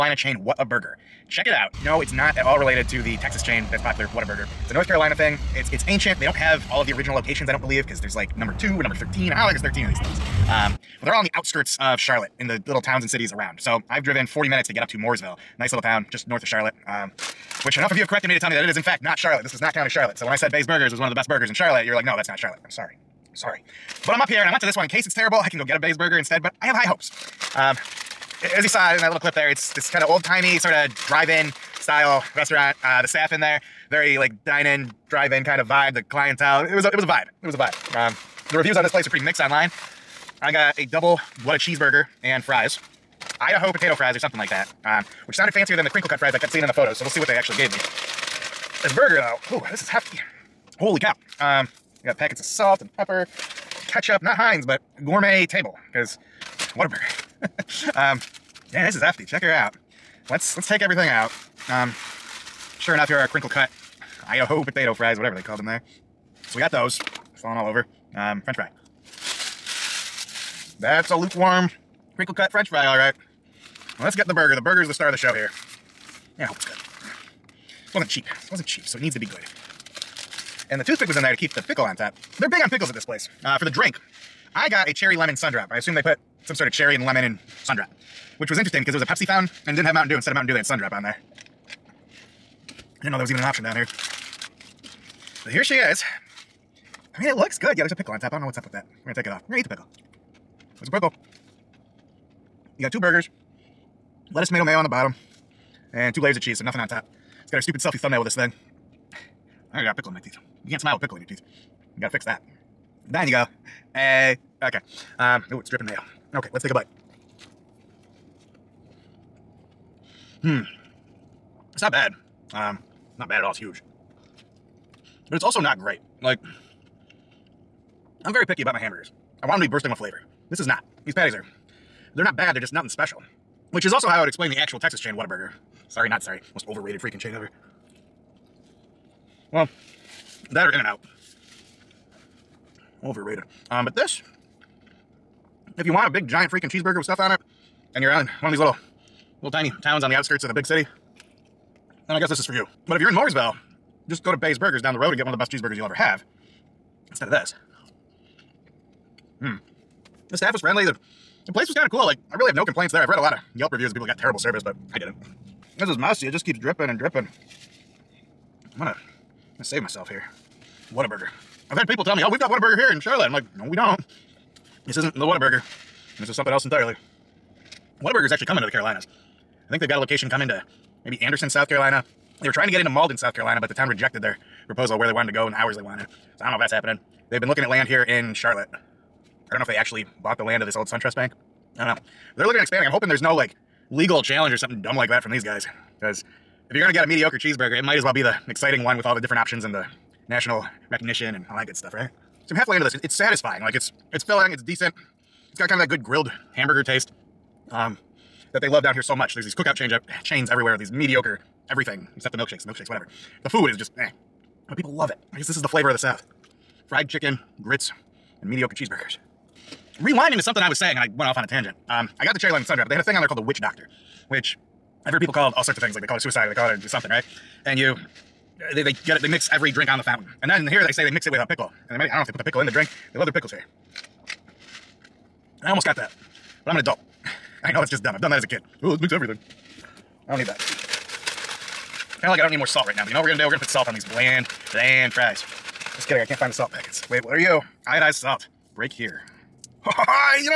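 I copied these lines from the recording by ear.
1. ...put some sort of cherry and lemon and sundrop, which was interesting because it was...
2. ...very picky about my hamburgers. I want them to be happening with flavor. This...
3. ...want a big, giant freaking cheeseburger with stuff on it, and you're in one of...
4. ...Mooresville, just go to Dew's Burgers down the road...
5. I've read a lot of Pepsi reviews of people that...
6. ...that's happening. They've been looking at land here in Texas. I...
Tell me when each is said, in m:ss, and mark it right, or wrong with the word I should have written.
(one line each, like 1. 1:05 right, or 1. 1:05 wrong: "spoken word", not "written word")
1. 1:26 right
2. 2:08 wrong: "bursting", not "happening"
3. 2:25 right
4. 2:33 wrong: "Bay", not "Dew"
5. 2:43 wrong: "Yelp", not "Pepsi"
6. 3:06 wrong: "Charlotte", not "Texas".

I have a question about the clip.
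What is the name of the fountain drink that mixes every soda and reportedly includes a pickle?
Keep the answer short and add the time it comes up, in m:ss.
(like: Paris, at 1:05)
witch doctor, at 3:43.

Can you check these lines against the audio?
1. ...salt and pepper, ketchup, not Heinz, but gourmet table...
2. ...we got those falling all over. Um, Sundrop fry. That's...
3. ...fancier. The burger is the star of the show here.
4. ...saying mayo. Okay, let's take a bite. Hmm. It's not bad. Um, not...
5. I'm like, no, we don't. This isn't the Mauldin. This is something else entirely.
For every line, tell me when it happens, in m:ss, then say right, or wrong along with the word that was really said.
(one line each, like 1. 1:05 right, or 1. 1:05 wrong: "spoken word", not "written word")
1. 0:52 right
2. 1:06 wrong: "French", not "Sundrop"
3. 1:14 wrong: "burger", not "fancier"
4. 1:55 wrong: "dripping", not "saying"
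5. 2:53 wrong: "Whataburger", not "Mauldin".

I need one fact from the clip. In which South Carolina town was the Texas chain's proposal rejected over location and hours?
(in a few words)
Mauldin.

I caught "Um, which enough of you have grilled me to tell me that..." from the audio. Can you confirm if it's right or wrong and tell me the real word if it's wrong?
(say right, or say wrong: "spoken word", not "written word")
wrong: "corrected", not "grilled".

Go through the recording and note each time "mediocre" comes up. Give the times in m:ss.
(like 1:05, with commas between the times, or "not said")
3:17, 3:30, 3:38.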